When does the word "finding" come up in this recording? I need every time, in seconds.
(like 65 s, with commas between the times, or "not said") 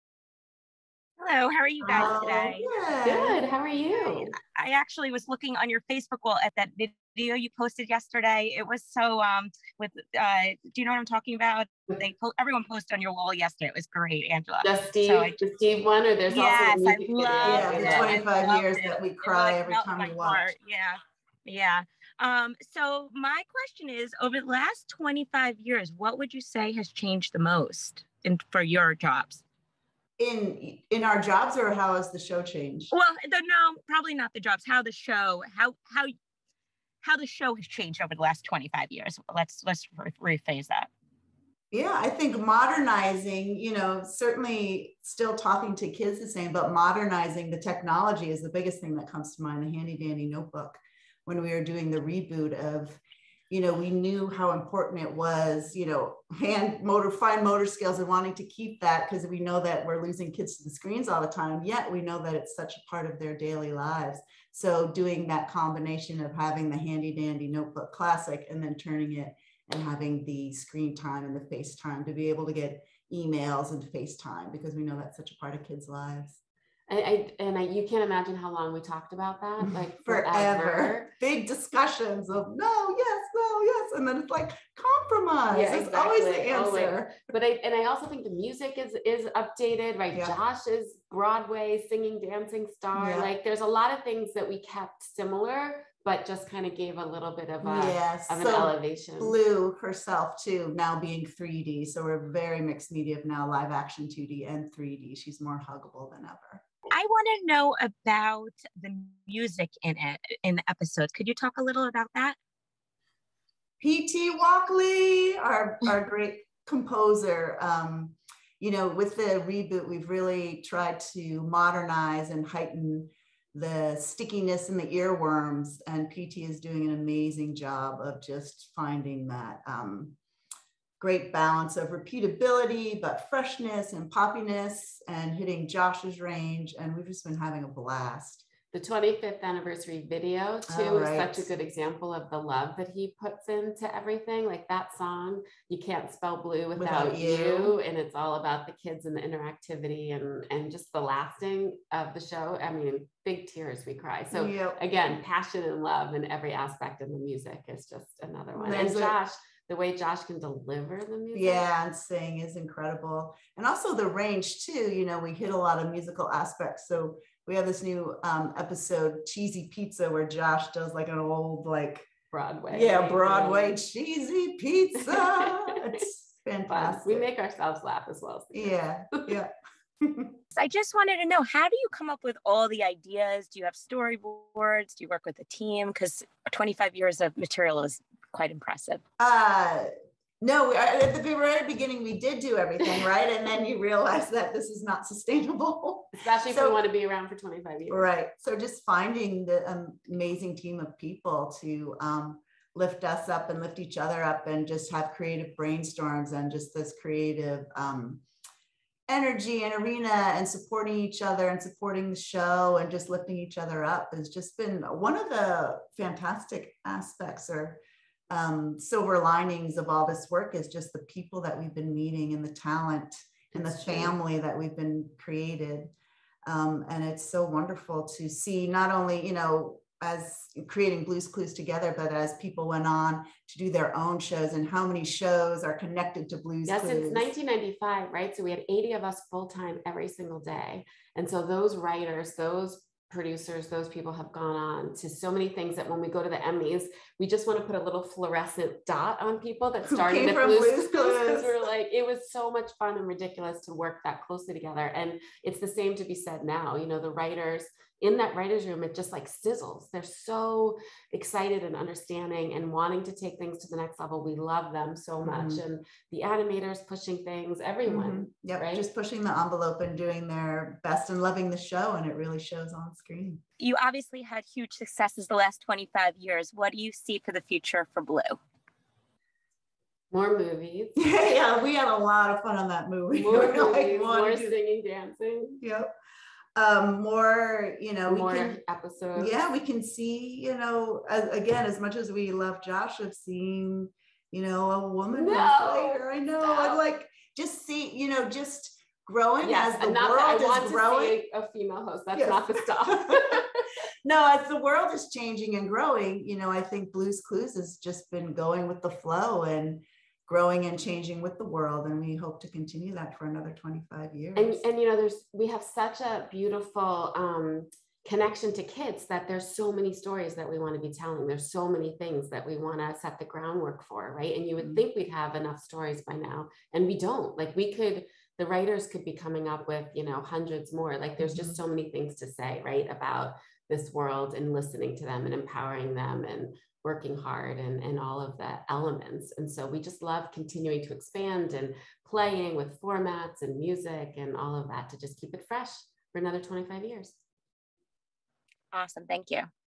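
128 s, 198 s.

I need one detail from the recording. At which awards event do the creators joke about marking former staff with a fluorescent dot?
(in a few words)
the Emmys.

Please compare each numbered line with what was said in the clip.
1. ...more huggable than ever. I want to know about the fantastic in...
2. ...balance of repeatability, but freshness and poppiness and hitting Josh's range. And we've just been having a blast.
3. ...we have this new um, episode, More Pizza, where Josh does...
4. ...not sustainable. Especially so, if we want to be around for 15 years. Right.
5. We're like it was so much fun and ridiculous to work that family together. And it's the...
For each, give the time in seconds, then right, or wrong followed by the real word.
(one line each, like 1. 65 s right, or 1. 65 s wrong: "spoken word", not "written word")
1. 105 s wrong: "music", not "fantastic"
2. 131 s right
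3. 167 s wrong: "Cheesy", not "More"
4. 194 s wrong: "25", not "15"
5. 251 s wrong: "closely", not "family".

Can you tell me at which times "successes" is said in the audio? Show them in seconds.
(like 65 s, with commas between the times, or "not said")
274 s.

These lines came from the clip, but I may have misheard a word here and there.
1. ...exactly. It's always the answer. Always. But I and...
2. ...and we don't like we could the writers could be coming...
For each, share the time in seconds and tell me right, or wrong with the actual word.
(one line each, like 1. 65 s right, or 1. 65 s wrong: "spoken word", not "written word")
1. 85 s right
2. 326 s right.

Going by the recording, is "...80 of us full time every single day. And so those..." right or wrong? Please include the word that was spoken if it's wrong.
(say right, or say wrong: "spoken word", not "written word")
right.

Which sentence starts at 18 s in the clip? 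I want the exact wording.
that we cry every time we watch.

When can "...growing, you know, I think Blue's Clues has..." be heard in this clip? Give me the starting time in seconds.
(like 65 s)
305 s.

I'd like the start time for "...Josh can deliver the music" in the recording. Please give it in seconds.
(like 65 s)
159 s.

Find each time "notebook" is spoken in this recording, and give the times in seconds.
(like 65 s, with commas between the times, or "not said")
50 s, 67 s.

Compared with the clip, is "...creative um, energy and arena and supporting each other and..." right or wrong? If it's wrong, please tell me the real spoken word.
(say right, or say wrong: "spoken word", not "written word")
right.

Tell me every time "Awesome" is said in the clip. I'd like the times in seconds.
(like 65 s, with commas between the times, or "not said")
348 s.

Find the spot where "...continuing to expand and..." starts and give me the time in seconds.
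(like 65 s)
340 s.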